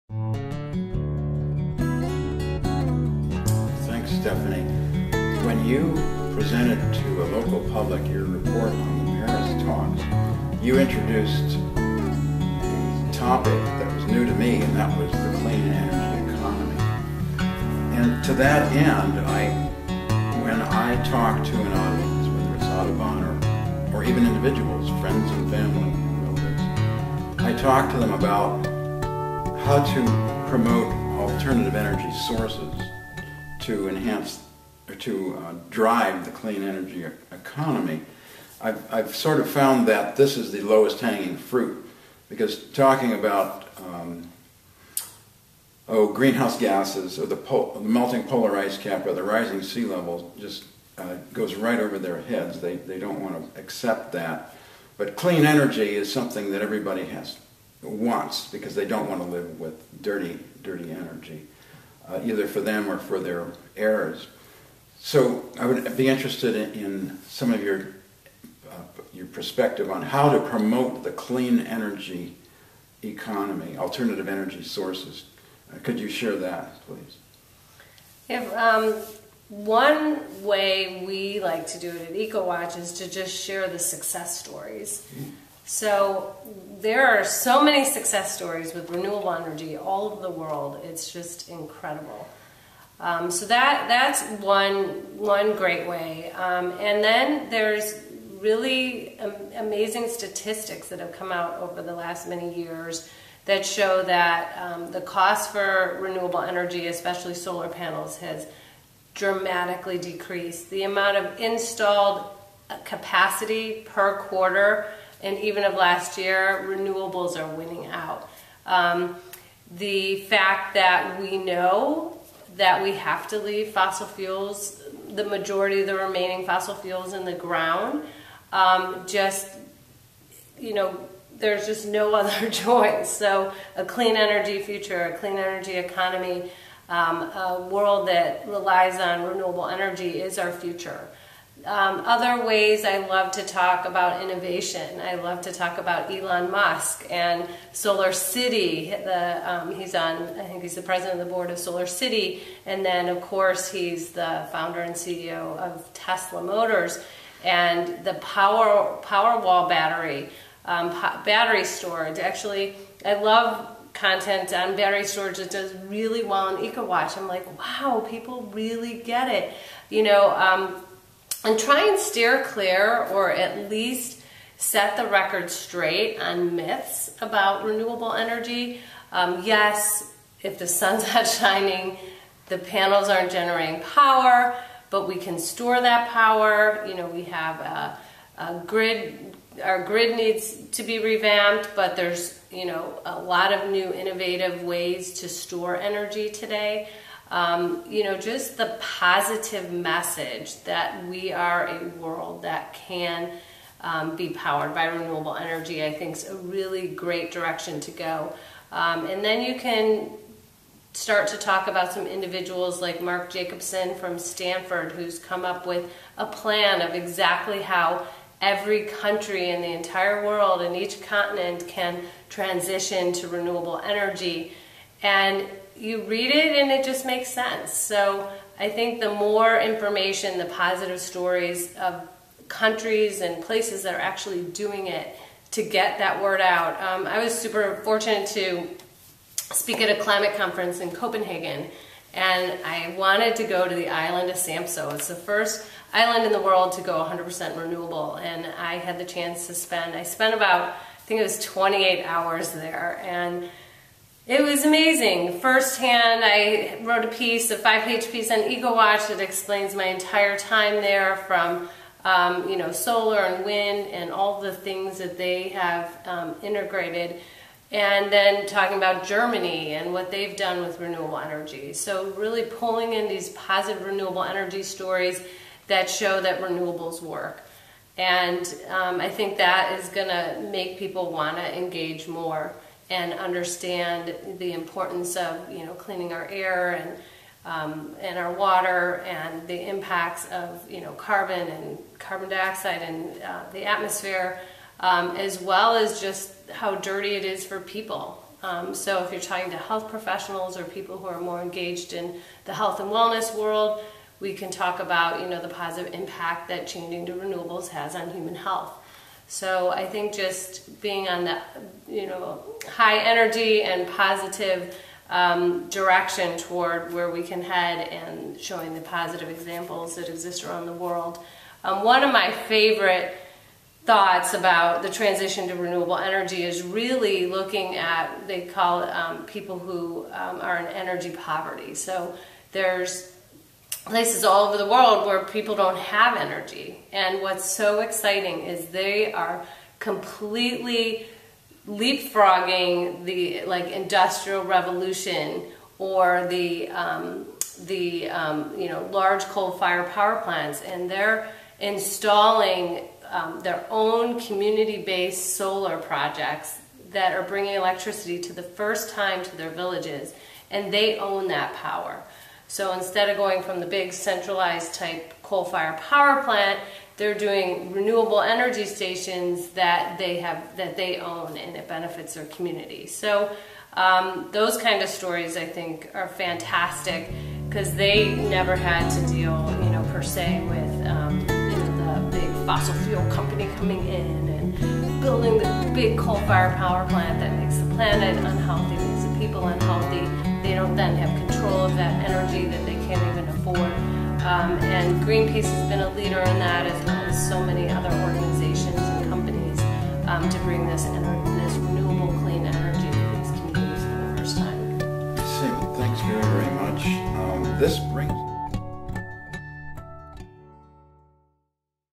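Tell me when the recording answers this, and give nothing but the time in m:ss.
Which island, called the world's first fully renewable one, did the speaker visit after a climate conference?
4:04.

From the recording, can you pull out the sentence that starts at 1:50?
The amount of installed uh, capacity per quarter and even of last year, renewables are winning out.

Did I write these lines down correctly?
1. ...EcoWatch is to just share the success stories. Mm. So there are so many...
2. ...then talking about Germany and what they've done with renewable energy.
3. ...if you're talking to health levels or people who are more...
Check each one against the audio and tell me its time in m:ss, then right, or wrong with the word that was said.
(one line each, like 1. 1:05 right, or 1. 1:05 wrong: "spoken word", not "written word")
1. 1:22 right
2. 4:28 right
3. 4:59 wrong: "professionals", not "levels".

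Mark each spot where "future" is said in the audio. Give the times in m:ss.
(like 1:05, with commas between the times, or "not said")
2:14, 2:20.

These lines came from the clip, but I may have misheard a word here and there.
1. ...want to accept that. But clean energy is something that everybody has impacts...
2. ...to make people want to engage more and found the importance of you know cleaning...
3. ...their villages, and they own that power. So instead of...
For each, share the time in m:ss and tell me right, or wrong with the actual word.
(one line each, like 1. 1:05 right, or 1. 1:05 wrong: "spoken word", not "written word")
1. 0:53 wrong: "wants", not "impacts"
2. 4:40 wrong: "understand", not "found"
3. 5:59 right.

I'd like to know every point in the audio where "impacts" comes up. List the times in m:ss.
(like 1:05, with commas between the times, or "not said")
4:49, 5:05.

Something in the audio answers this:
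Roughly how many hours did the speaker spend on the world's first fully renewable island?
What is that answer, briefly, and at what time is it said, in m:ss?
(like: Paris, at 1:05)
28, at 4:11.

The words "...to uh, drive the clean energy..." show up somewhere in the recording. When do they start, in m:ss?
0:34.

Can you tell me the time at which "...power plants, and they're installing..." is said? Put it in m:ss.
5:49.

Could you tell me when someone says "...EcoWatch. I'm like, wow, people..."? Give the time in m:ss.
2:46.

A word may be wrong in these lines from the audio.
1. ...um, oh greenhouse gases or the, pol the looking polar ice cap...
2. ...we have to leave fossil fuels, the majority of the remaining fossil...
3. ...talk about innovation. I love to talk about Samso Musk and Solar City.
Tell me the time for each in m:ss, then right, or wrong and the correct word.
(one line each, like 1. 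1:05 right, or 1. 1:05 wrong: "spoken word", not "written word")
1. 0:43 wrong: "melting", not "looking"
2. 2:02 right
3. 2:23 wrong: "Elon", not "Samso".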